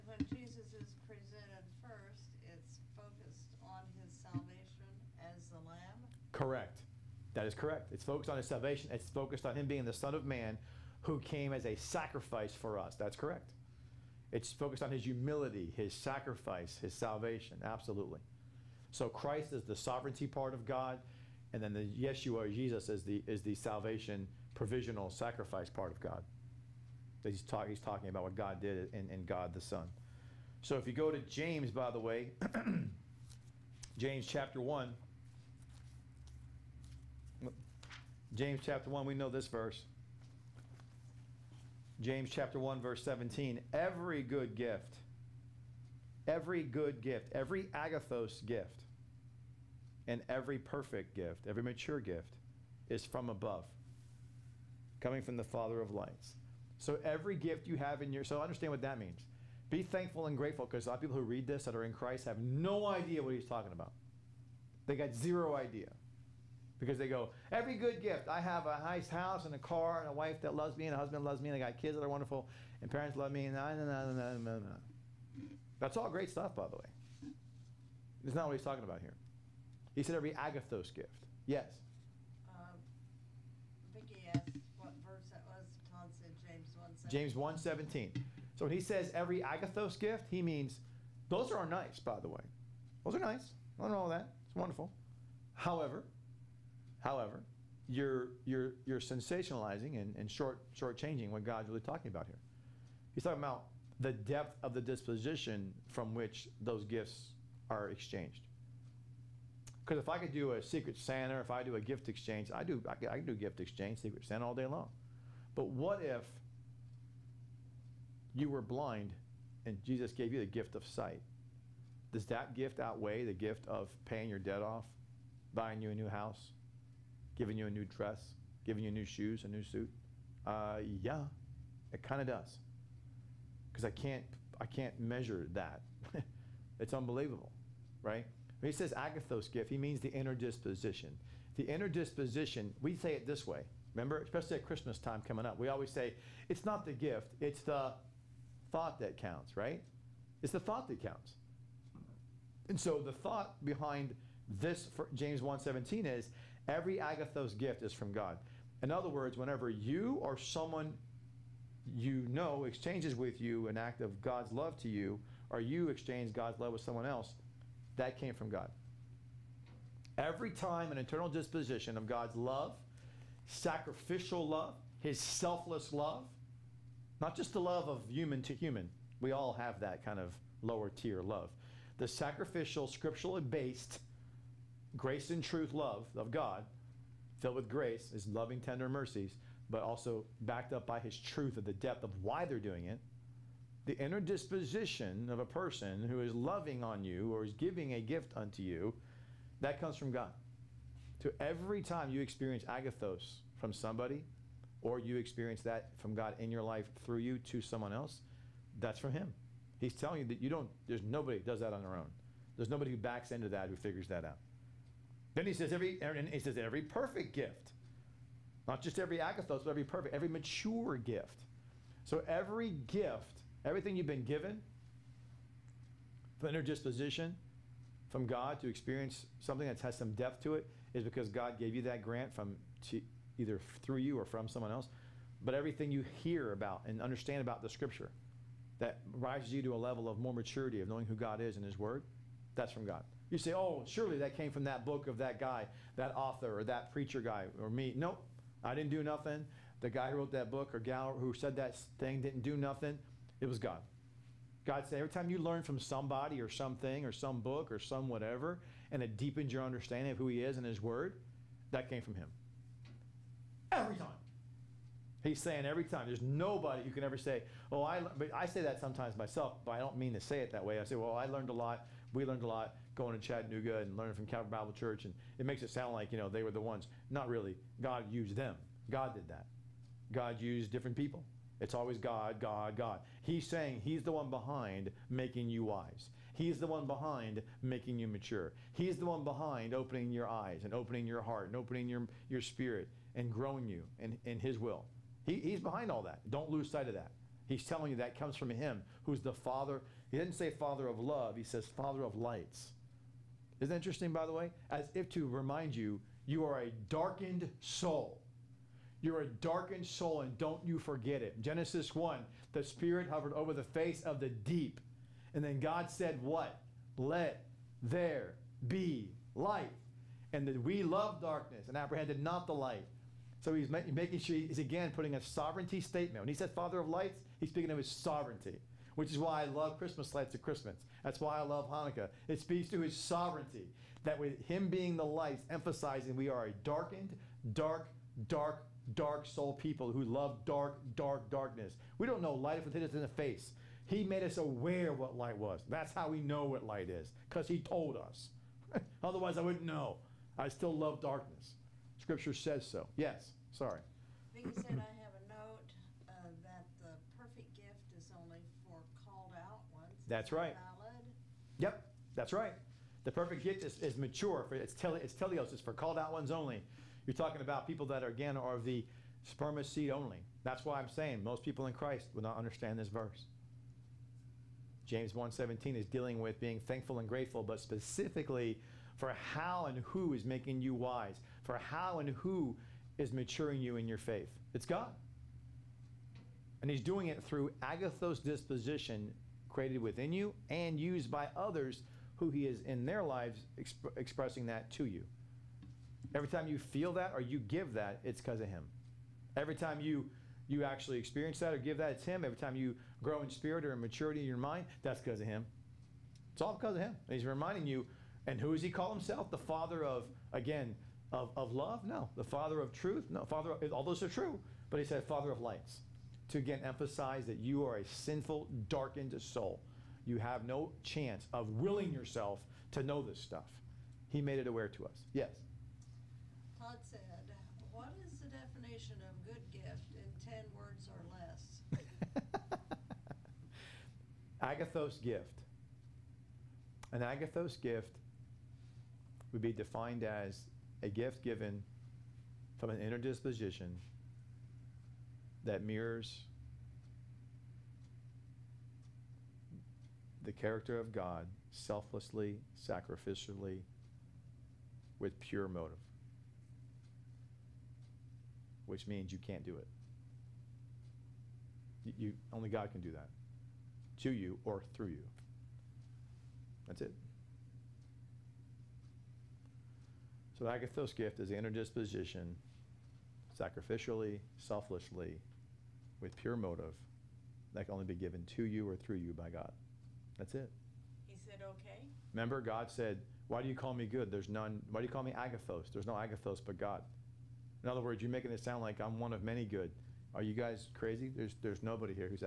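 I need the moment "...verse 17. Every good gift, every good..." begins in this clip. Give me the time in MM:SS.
00:42.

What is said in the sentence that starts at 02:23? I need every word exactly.
Remember, especially at Christmas time coming up, we always say, it's not the gift, it's the thought that counts, right?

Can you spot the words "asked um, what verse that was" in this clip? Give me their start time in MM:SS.
01:22.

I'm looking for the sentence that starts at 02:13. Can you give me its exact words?
Because I can't I can't measure that.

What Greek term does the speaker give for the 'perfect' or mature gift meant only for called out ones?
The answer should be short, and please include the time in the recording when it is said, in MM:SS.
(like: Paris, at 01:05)
teleos, at 06:05.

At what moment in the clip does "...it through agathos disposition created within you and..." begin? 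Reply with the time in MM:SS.
06:27.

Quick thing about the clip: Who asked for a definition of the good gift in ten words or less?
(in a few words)
Todd.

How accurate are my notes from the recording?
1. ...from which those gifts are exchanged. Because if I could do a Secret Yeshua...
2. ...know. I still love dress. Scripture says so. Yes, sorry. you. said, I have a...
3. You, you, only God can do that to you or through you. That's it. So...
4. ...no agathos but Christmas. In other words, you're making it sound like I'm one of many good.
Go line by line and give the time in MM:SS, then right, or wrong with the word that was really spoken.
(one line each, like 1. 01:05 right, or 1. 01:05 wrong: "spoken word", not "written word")
1. 01:45 wrong: "Santa", not "Yeshua"
2. 05:49 wrong: "darkness", not "dress"
3. 07:41 right
4. 08:05 wrong: "God", not "Christmas".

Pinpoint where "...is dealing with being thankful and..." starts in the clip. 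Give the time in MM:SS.
06:15.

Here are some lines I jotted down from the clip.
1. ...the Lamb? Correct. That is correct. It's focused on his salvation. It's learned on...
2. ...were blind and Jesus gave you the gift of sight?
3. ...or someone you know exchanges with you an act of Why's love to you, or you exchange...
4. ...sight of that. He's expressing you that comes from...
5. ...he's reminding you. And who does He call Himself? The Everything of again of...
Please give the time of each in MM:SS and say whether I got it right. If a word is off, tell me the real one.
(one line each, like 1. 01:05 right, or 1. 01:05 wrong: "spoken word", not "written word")
1. 00:05 wrong: "focused", not "learned"
2. 01:58 right
3. 02:40 wrong: "God", not "Why"
4. 04:56 wrong: "telling", not "expressing"
5. 06:47 wrong: "Father", not "Everything".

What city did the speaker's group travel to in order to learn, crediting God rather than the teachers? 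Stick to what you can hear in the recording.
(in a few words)
Chattanooga.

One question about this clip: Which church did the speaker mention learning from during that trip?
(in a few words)
Calvary Bible Church.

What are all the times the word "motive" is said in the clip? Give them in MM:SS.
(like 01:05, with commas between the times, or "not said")
07:35, 07:56.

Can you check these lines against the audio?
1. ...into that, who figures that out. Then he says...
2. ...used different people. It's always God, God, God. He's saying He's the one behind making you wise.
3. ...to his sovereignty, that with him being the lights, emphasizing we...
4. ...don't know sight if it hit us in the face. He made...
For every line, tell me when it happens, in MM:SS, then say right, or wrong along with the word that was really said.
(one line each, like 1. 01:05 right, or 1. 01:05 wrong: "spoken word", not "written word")
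1. 03:33 right
2. 04:40 right
3. 05:32 right
4. 05:42 wrong: "light", not "sight".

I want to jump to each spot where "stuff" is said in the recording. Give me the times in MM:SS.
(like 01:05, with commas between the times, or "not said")
01:16, 07:03.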